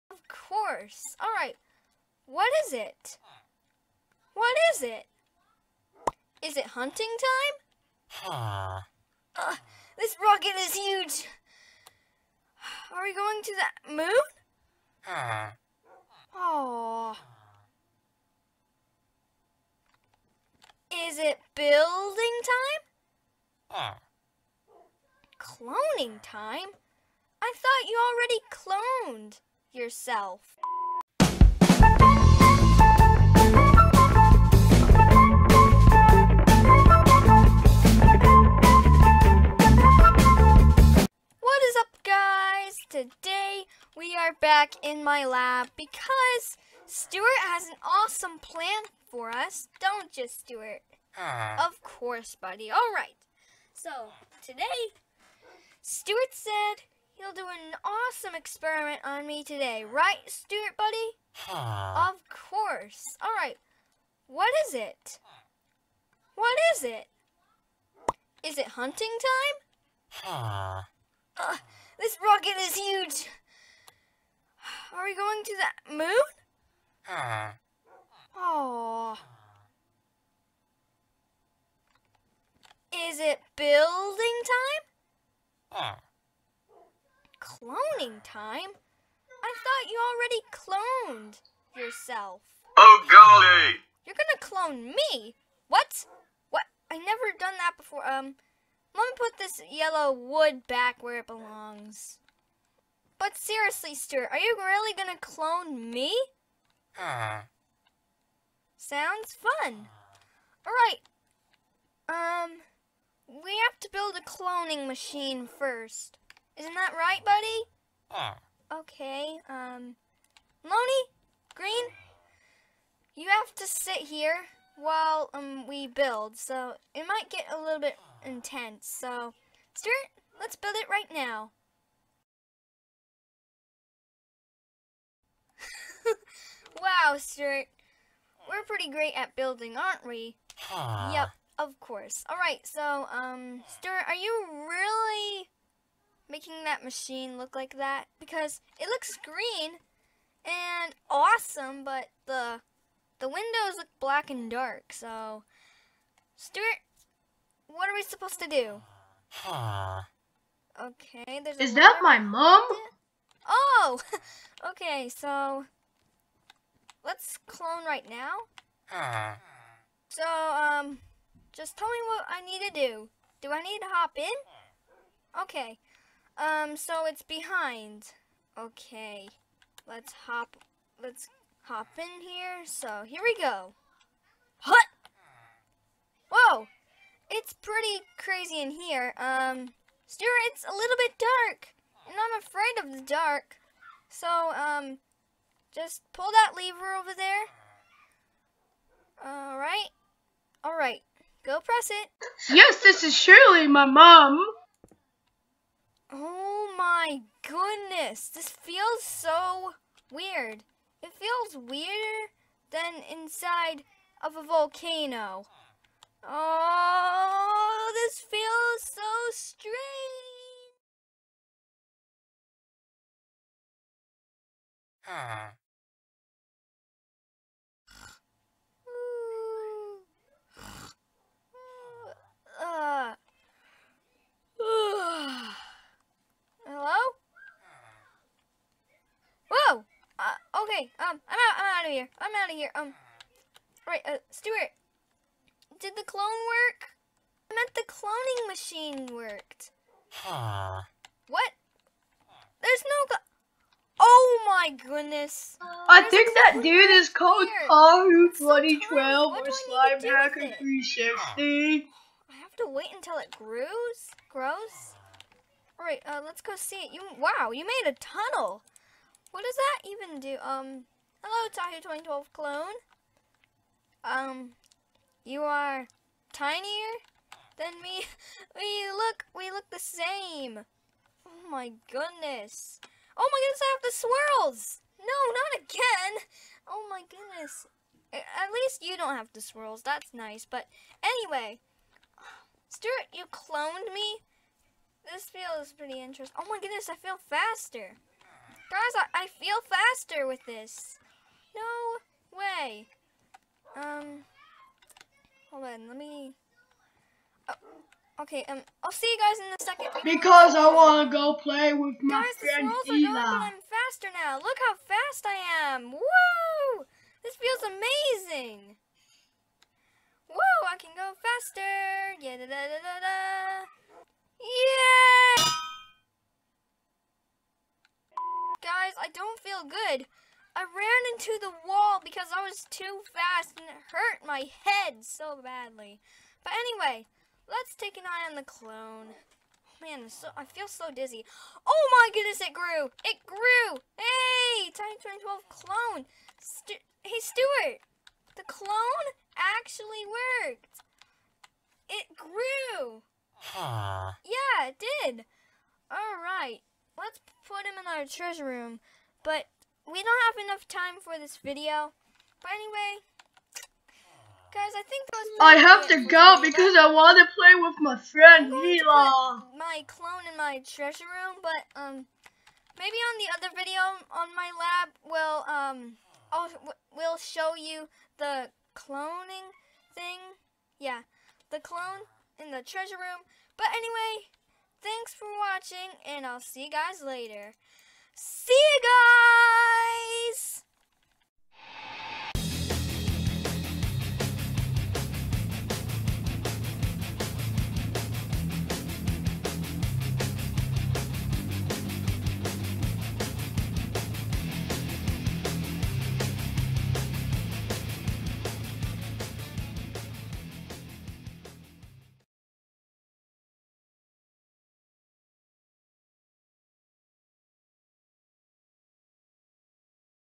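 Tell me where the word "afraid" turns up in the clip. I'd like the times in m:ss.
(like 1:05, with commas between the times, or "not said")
3:12.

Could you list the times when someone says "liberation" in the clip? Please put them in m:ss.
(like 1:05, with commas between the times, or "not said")
not said.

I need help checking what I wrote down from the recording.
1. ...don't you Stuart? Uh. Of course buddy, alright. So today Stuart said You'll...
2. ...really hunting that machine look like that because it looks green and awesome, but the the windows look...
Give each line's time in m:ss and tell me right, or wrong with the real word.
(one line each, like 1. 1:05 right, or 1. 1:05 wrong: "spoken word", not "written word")
1. 0:49 right
2. 2:24 wrong: "making", not "hunting".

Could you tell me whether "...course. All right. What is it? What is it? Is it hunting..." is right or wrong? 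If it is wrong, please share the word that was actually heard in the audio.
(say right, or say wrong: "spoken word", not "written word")
right.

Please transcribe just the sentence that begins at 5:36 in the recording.
But anyway, let's take an eye on the clone.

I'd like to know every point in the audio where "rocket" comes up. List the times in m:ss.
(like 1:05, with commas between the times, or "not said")
0:10, 1:12.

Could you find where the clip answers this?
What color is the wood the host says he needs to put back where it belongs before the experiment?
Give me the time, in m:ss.
1:39.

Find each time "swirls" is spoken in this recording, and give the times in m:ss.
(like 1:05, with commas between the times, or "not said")
4:43, 4:49.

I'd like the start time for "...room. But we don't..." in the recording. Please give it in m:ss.
5:58.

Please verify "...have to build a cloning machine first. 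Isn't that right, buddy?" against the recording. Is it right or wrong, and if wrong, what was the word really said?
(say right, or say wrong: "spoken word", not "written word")
right.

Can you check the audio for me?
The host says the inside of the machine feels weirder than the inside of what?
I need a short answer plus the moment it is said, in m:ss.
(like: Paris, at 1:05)
a volcano, at 3:34.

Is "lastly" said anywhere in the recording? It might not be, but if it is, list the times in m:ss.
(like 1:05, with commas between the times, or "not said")
not said.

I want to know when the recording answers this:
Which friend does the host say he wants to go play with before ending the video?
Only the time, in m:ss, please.
6:08.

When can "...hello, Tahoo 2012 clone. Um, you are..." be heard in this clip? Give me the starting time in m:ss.
4:31.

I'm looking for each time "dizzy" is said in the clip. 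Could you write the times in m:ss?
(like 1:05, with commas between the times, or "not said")
5:40.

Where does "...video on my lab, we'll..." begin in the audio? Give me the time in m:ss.
6:13.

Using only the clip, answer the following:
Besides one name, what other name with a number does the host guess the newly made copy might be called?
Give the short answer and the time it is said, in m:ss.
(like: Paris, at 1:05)
Slime 360, at 4:19.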